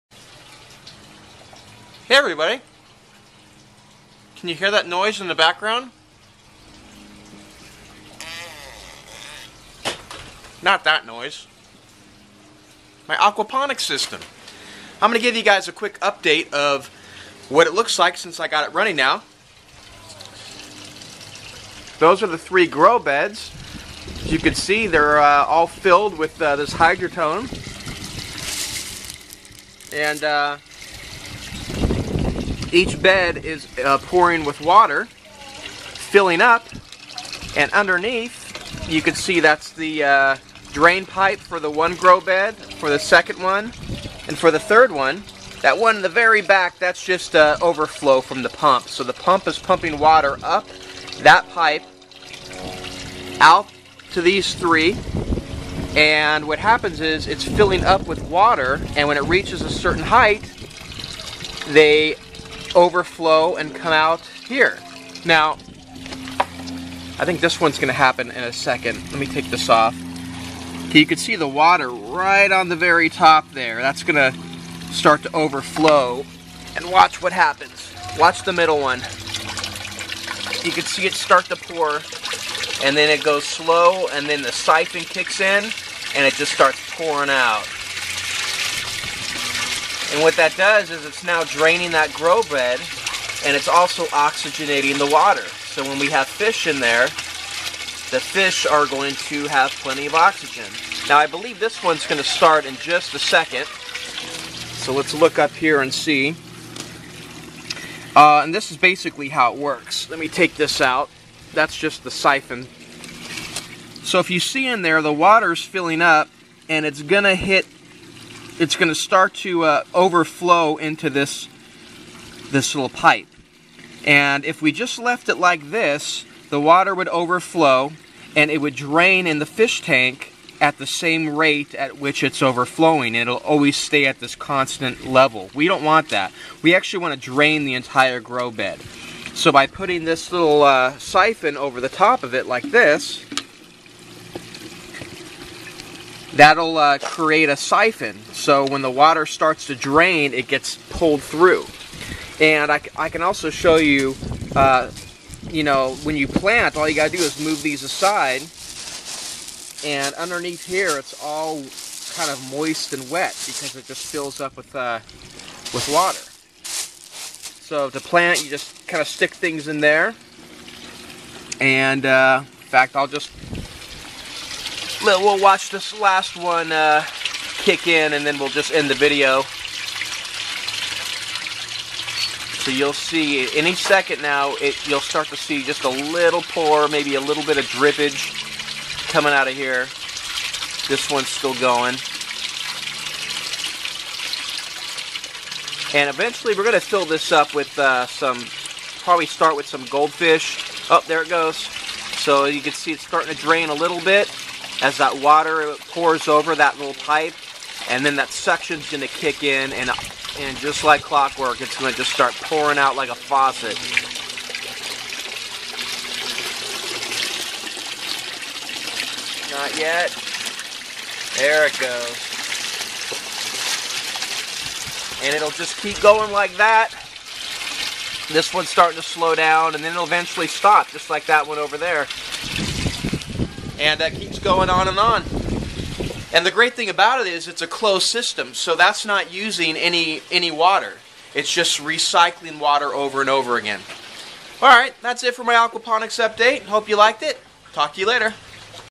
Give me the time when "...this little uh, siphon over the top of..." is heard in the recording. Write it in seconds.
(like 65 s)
140 s.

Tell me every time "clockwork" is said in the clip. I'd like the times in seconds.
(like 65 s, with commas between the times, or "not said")
211 s.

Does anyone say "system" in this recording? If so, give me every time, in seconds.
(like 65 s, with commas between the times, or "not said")
13 s, 238 s.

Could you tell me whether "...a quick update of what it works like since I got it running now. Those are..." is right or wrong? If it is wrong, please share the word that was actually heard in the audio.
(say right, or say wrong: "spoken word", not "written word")
wrong: "looks", not "works".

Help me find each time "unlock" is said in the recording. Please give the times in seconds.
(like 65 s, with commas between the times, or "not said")
not said.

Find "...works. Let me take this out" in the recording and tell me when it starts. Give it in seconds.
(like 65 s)
109 s.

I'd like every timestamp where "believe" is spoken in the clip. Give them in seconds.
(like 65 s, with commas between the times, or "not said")
101 s.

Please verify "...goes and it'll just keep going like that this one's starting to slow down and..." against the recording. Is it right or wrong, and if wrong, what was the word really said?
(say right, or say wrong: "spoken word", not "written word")
right.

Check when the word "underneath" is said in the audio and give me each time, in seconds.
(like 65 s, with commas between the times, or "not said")
37 s, 160 s.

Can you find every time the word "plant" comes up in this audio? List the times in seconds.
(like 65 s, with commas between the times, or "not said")
156 s, 167 s.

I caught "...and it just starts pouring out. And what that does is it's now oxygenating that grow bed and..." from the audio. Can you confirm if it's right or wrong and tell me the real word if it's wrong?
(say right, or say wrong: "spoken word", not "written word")
wrong: "draining", not "oxygenating".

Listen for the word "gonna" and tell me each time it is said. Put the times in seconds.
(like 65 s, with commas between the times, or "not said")
67 s, 74 s.